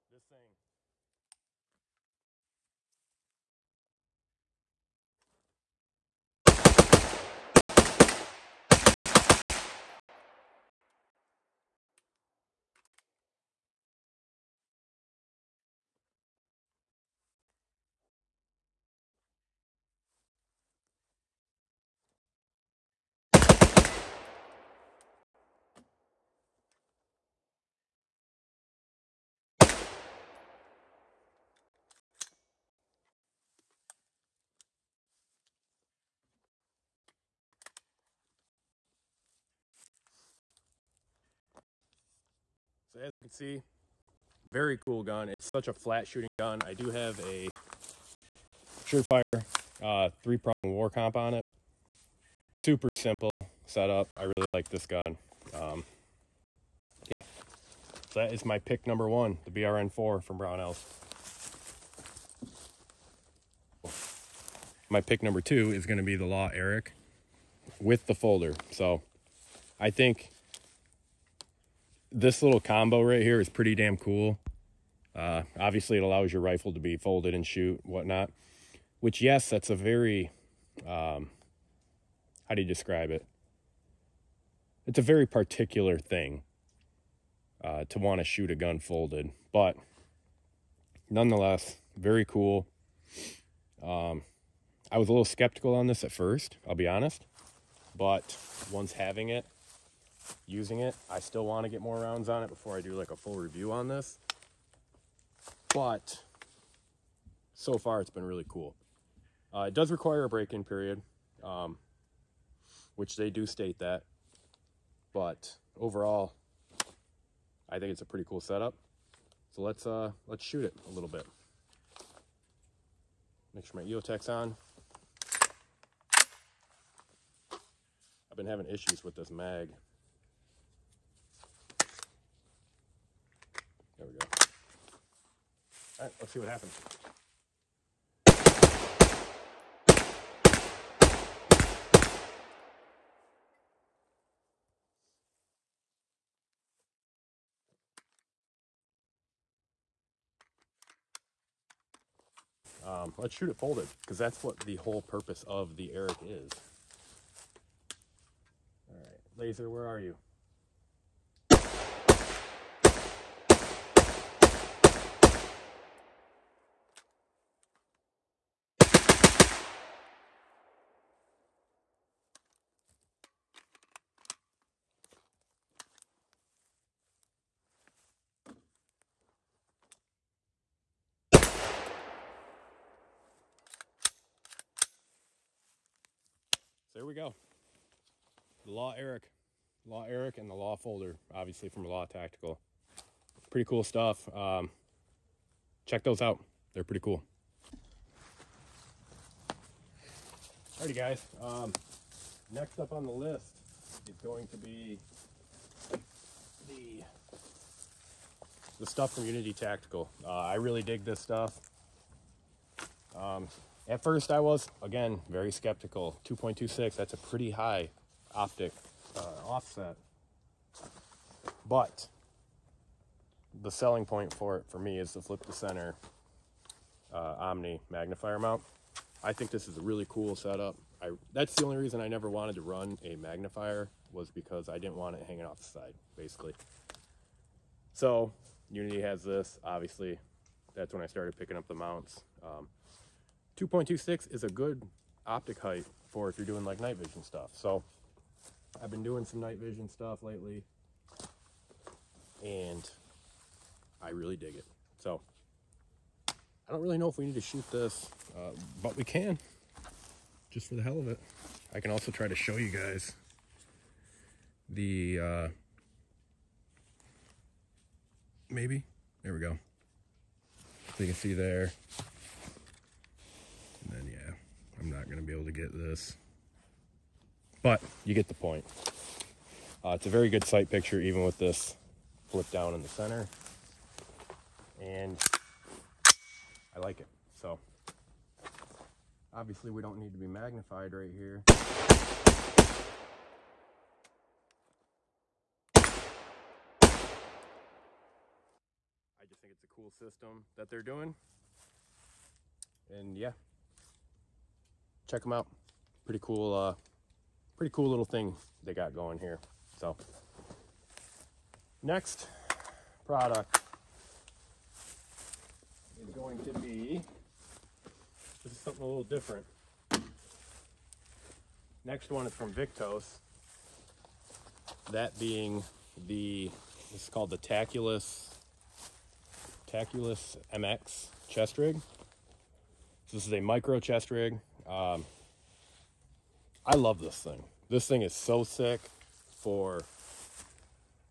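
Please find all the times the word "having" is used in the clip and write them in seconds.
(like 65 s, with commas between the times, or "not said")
98 s, 128 s.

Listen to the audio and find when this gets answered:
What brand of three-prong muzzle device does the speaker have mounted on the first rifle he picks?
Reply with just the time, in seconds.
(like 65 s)
48 s.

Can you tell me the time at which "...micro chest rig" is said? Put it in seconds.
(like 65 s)
333 s.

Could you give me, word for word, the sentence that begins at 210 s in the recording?
Uh, I really dig this stuff.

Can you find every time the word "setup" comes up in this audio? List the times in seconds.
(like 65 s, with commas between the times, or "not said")
53 s, 118 s, 230 s.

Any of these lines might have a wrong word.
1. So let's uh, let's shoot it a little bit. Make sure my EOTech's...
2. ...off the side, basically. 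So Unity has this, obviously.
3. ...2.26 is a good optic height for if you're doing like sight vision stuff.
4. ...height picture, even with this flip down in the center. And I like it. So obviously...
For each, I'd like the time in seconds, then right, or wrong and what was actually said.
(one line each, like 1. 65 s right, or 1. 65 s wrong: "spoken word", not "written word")
1. 119 s right
2. 235 s right
3. 243 s wrong: "night", not "sight"
4. 280 s wrong: "sight", not "height".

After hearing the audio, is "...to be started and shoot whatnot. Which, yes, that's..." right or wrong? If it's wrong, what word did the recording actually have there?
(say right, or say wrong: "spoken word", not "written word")
wrong: "folded", not "started".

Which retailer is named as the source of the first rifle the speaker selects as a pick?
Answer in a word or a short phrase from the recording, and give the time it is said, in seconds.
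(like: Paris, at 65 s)
Brownells, at 60 s.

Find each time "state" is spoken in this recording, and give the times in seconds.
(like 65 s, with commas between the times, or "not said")
113 s.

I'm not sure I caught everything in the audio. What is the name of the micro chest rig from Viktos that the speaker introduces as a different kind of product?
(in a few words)
Taculus MX.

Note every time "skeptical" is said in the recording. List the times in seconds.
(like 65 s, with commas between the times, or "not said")
95 s, 215 s.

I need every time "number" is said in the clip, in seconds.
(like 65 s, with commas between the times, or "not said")
58 s, 65 s.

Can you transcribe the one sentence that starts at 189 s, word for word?
Law Eric and the Law Folder, obviously from Law Tactical.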